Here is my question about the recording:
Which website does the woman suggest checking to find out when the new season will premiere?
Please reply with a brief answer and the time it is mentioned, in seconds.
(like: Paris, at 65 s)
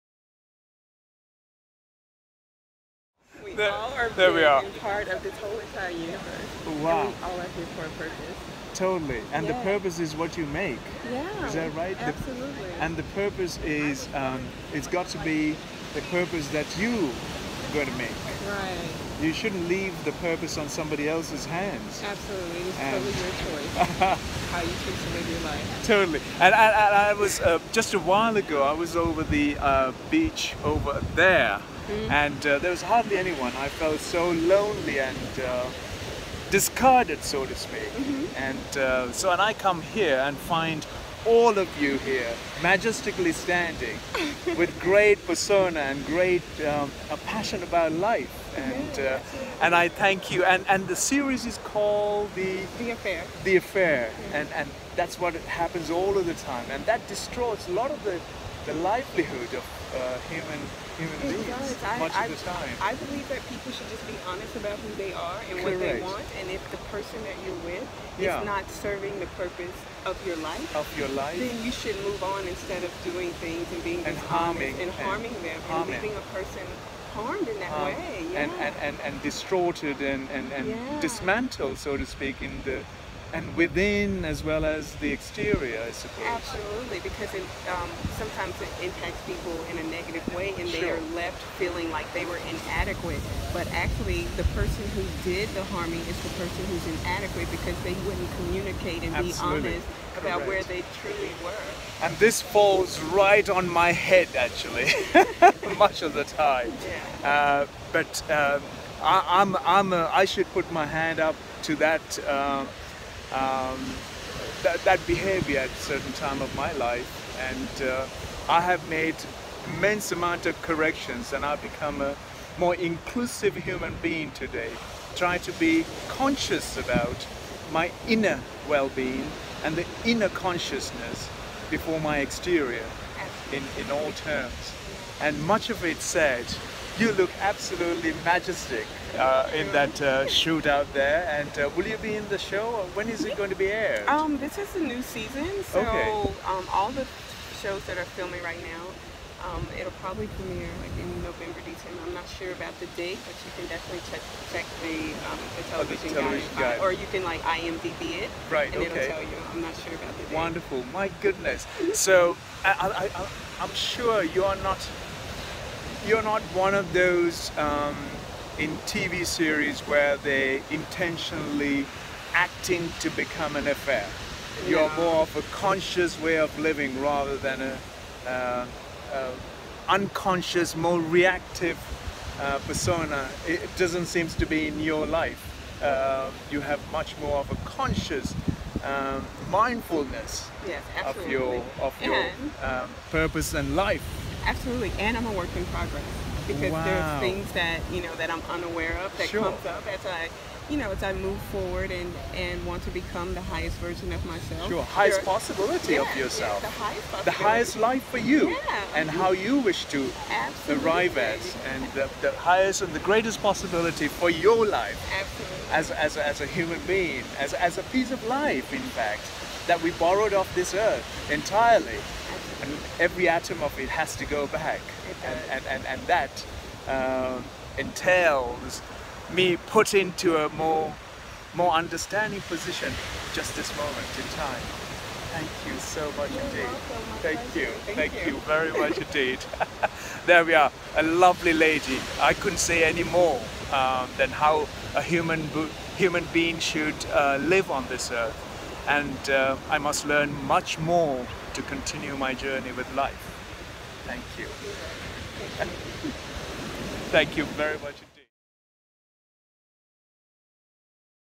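IMDb, at 157 s.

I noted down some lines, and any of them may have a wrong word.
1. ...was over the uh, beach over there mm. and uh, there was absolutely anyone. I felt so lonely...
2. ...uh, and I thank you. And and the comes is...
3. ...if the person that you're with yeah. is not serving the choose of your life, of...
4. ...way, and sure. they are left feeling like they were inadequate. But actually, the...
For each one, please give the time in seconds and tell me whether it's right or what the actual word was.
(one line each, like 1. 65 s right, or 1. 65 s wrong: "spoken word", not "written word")
1. 28 s wrong: "hardly", not "absolutely"
2. 48 s wrong: "series", not "comes"
3. 66 s wrong: "purpose", not "choose"
4. 90 s right.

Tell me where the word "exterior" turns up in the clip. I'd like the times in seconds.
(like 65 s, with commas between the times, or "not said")
85 s, 132 s.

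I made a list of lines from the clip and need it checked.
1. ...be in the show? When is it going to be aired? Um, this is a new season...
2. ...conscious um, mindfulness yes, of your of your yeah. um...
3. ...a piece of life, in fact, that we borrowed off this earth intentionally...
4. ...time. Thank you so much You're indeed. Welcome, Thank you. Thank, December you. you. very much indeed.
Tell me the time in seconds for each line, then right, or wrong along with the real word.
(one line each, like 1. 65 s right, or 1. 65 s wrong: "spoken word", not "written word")
1. 141 s right
2. 187 s right
3. 217 s wrong: "entirely", not "intentionally"
4. 234 s wrong: "Thank", not "December".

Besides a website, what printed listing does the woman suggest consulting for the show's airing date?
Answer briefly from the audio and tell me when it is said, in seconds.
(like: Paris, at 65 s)
the television guide, at 156 s.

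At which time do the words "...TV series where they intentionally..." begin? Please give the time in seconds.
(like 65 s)
168 s.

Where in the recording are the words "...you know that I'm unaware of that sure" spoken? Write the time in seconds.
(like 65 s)
197 s.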